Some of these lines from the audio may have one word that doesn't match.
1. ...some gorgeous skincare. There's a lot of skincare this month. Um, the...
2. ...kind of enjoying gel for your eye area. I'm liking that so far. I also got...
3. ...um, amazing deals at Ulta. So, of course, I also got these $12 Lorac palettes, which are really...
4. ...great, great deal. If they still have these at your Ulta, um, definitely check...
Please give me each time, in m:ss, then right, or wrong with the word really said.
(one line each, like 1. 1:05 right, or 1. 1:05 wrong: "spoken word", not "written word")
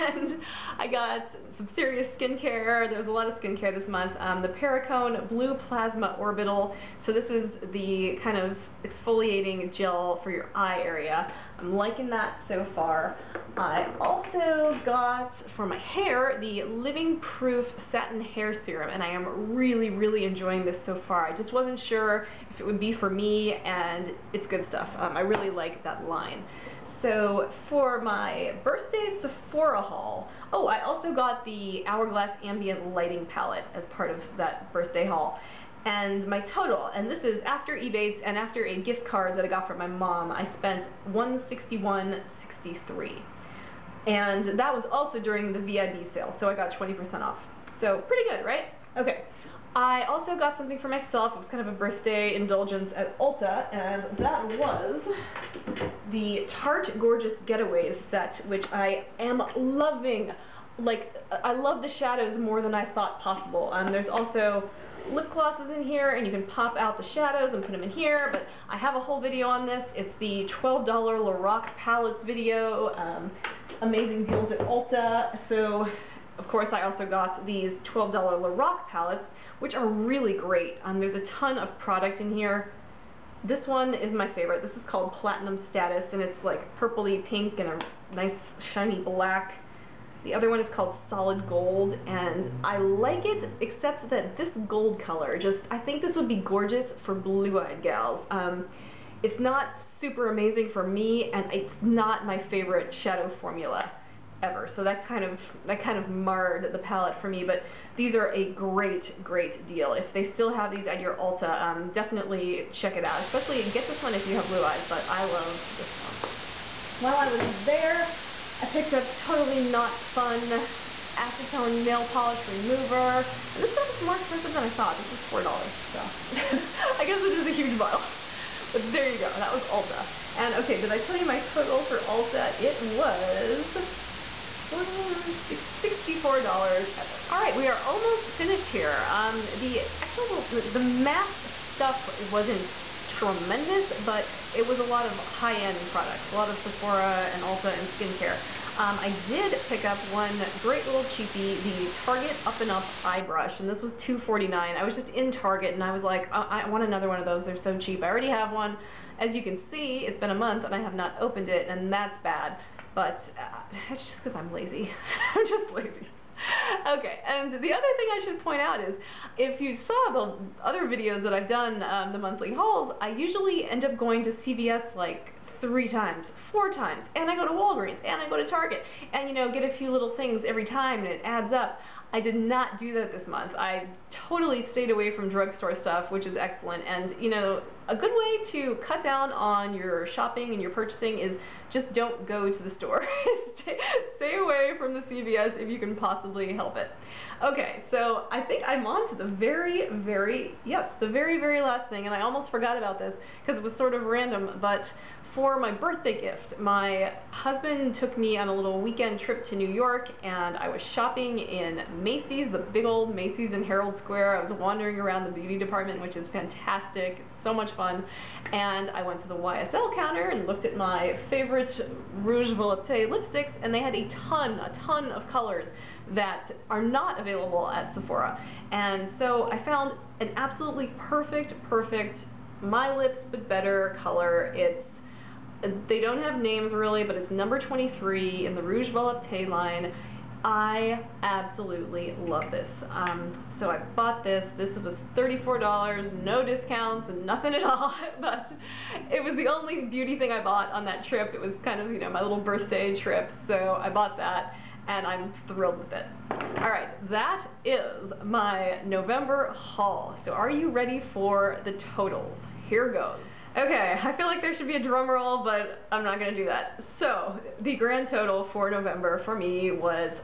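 1. 0:01 wrong: "serious", not "gorgeous"
2. 0:08 wrong: "exfoliating", not "enjoying"
3. 1:12 right
4. 1:48 right.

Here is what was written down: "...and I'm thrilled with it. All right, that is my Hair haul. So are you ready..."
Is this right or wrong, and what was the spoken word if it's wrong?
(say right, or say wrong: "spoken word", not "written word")
wrong: "November", not "Hair".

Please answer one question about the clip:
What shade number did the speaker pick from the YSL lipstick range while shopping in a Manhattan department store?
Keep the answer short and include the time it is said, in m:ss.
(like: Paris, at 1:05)
23, at 3:57.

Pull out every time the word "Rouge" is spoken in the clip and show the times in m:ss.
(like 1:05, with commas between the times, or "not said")
3:42, 3:58.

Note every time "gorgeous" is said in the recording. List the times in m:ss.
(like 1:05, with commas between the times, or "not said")
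0:56, 1:36.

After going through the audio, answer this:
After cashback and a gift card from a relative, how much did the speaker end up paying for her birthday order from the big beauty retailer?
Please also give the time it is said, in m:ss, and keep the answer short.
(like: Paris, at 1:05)
$161.63, at 0:41.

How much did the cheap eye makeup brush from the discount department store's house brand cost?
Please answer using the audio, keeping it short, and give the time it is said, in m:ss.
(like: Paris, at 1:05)
$2.49, at 2:34.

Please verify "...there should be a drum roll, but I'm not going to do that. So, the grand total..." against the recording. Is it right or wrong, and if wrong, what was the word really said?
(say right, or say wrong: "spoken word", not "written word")
right.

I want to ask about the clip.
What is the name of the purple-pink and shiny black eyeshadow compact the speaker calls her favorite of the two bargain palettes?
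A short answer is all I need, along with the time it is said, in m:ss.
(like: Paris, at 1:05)
Platinum Status, at 1:25.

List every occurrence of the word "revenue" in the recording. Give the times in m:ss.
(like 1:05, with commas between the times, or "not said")
not said.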